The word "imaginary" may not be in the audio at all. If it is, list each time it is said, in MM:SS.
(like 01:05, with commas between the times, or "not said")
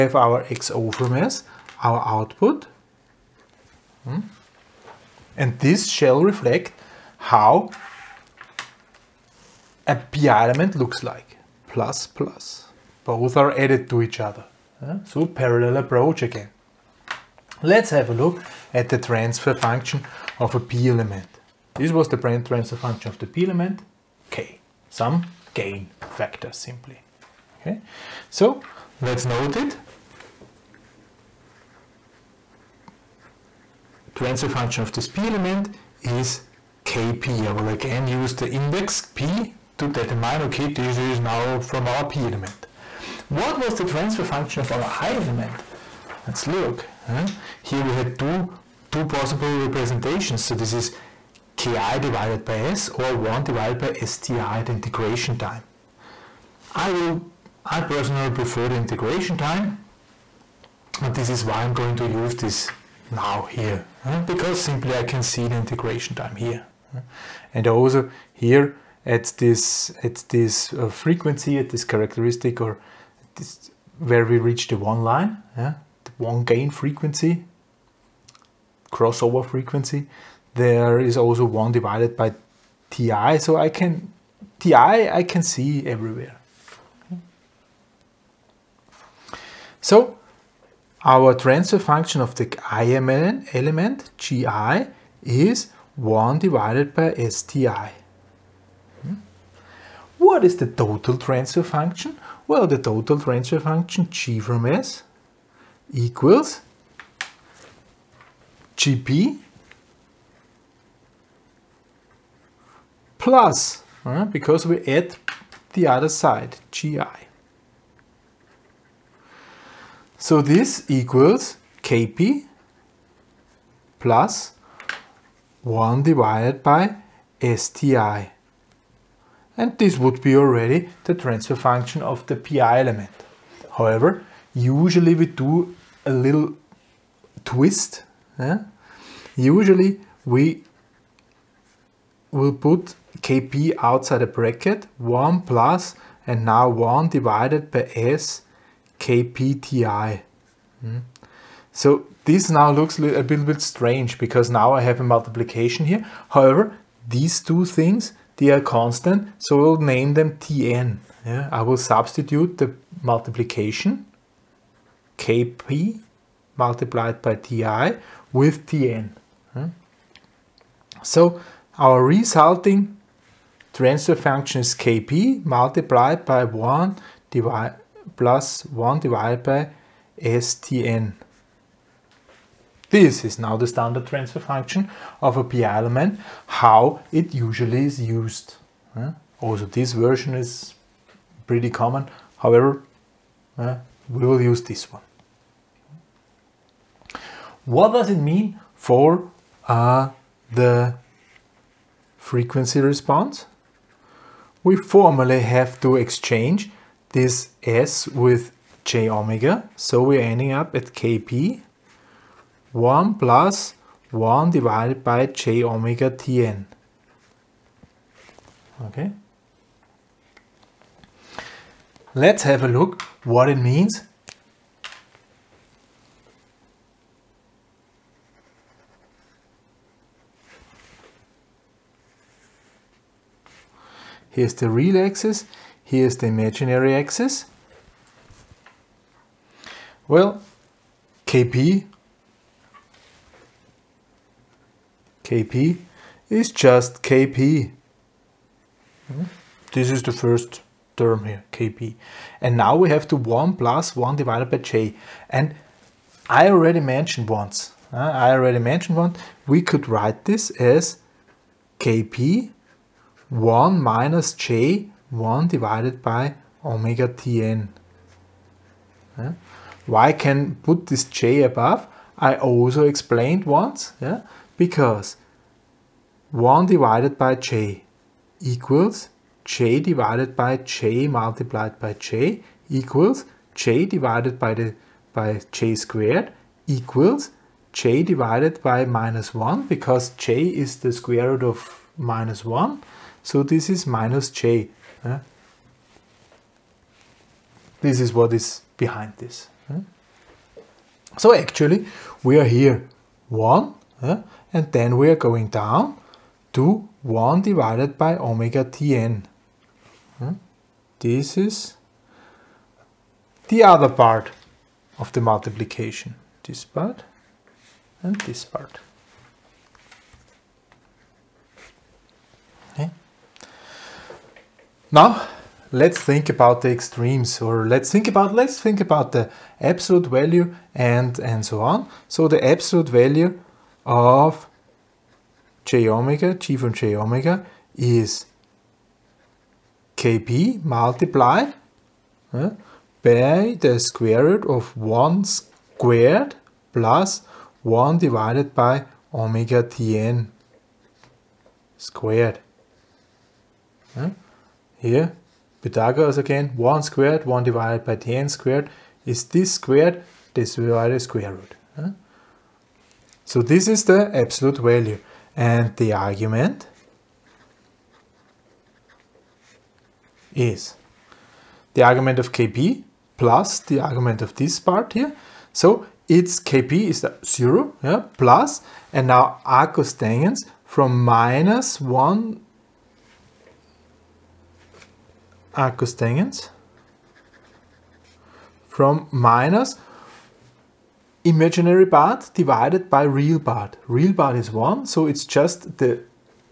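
03:56, 06:31.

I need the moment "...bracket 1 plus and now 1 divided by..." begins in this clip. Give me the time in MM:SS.
02:24.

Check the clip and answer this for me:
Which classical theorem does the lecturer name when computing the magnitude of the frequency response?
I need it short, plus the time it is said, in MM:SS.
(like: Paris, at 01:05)
Pythagoras, at 05:55.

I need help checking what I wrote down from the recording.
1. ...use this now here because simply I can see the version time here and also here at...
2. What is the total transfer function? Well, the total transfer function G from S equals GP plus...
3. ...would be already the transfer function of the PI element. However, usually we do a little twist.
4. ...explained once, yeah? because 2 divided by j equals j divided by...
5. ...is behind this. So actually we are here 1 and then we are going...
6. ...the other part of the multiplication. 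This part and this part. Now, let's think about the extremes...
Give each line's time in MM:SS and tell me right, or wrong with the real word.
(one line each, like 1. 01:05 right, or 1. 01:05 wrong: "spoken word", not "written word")
1. 01:02 wrong: "integration", not "version"
2. 01:40 right
3. 02:09 right
4. 04:32 wrong: "1", not "2"
5. 04:58 right
6. 05:13 right.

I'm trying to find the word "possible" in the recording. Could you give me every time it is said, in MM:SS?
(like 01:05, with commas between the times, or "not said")
00:49.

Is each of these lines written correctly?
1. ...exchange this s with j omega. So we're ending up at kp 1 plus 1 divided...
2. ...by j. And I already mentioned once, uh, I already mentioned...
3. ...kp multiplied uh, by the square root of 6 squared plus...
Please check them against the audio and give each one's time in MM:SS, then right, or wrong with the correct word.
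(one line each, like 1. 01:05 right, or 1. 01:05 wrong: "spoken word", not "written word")
1. 03:25 right
2. 04:14 right
3. 05:39 wrong: "1", not "6".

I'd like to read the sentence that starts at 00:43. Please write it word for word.
What was the transfer function of our i element?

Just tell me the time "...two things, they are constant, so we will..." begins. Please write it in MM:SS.
02:37.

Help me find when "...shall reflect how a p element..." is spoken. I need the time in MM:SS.
00:05.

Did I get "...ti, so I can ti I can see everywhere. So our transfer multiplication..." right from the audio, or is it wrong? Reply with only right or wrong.
wrong.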